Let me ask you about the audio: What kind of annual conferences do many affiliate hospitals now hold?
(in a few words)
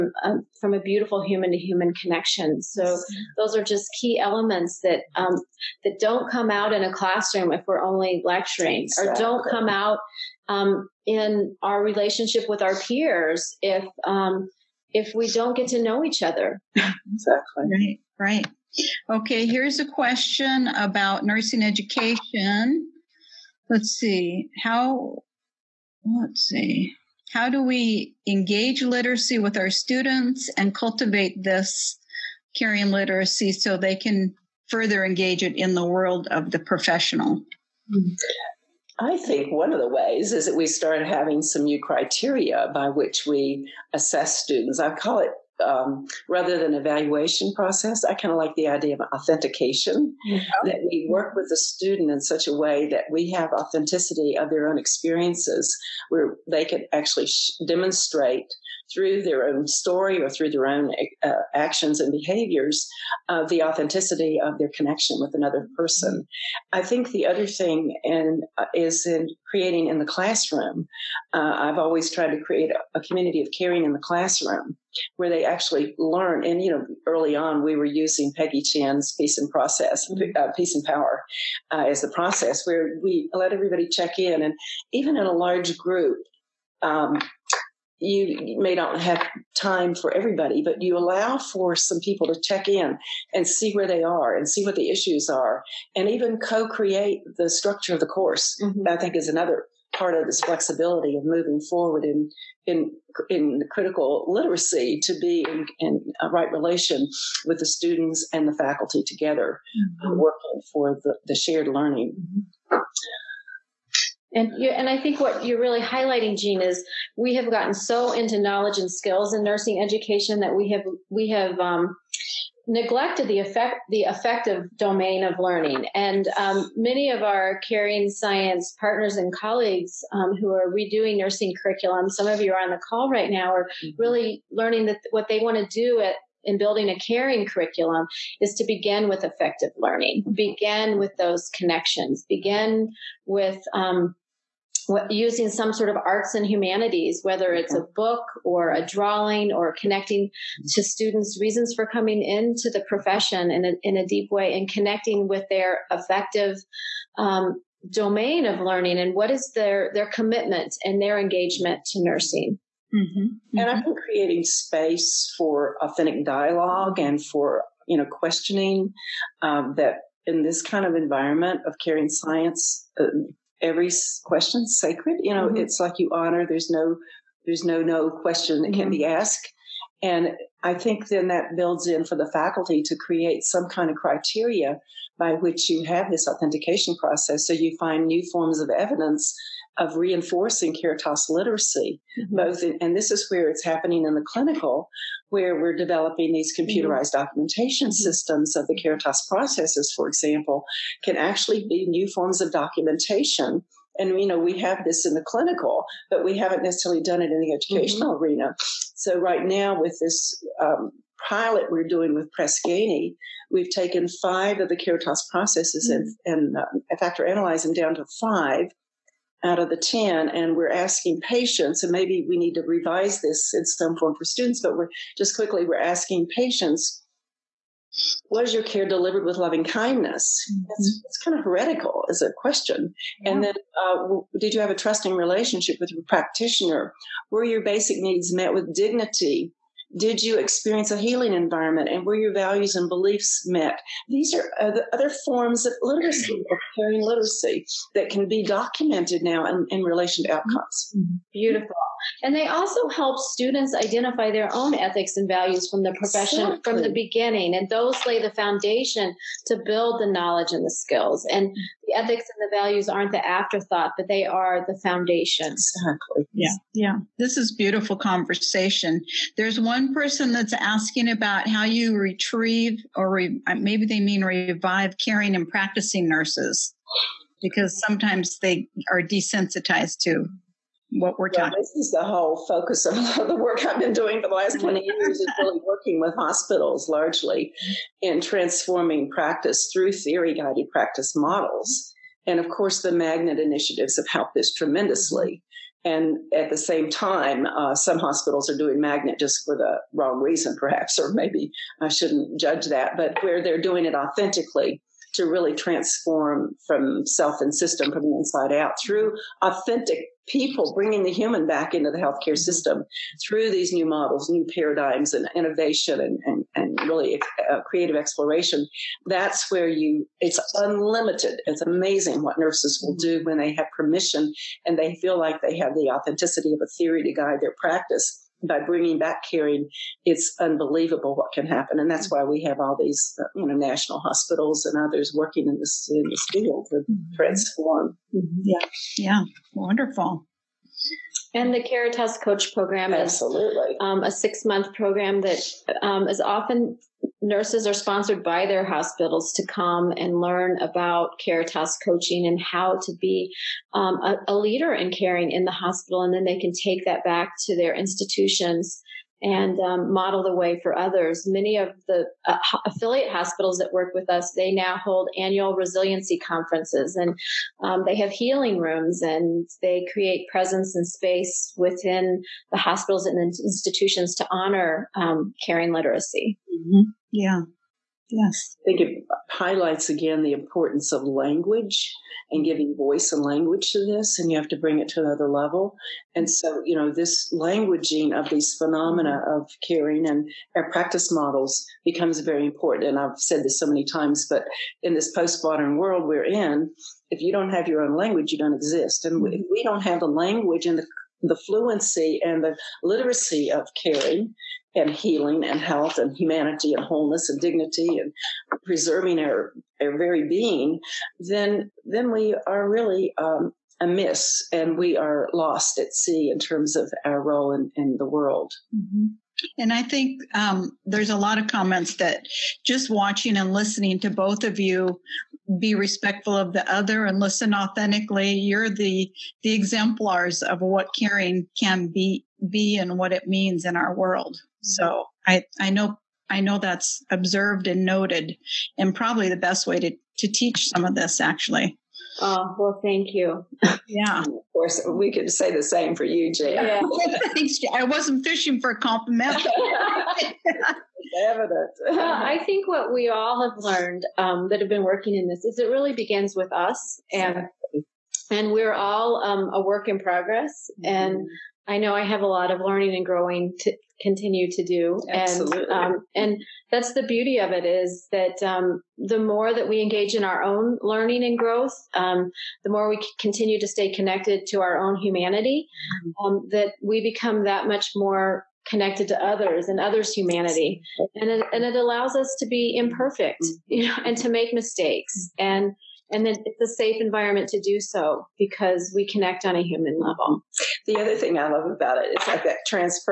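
resiliency conferences.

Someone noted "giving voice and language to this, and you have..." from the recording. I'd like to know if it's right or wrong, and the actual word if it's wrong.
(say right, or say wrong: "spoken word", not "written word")
right.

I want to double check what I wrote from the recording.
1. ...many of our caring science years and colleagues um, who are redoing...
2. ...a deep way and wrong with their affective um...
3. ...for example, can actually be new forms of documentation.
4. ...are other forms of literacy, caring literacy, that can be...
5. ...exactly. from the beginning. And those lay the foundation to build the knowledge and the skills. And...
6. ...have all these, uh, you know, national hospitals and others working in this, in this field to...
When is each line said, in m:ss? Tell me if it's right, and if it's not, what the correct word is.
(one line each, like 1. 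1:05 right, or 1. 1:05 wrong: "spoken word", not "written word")
1. 2:06 wrong: "partners", not "years"
2. 2:33 wrong: "connecting", not "wrong"
3. 3:19 right
4. 4:04 right
5. 4:16 right
6. 5:32 right.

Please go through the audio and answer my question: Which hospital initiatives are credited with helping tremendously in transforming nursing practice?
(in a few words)
magnet initiatives.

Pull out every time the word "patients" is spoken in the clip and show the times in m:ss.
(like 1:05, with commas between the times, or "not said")
3:41, 3:46.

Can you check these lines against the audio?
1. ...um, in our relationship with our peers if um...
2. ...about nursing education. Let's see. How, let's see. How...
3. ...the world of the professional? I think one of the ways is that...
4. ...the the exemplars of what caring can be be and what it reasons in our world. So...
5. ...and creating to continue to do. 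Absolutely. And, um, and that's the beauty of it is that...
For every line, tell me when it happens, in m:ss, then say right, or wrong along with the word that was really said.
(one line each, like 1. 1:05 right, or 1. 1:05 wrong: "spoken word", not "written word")
1. 0:10 right
2. 0:20 right
3. 0:35 right
4. 7:08 wrong: "means", not "reasons"
5. 7:42 wrong: "growing", not "creating".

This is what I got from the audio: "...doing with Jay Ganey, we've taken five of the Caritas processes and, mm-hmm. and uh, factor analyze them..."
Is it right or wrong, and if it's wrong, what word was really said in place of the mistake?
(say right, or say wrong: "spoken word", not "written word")
wrong: "Press", not "Jay".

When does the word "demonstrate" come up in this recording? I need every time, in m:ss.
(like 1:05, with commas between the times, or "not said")
0:57.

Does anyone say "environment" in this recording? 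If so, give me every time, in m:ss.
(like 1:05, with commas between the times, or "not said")
2:50, 4:01, 8:06.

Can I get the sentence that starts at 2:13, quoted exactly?
really learning that what they want to do at, in building a caring curriculum is to begin with affective learning mm-hmm.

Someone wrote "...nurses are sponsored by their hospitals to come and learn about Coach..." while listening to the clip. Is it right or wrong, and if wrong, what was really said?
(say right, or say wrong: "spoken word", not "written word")
wrong: "Caritas", not "Coach".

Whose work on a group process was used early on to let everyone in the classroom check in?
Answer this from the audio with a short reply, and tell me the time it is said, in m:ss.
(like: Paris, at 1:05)
Peggy Chinn, at 1:18.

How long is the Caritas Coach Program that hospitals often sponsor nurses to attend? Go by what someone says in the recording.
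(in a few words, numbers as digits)
6 months.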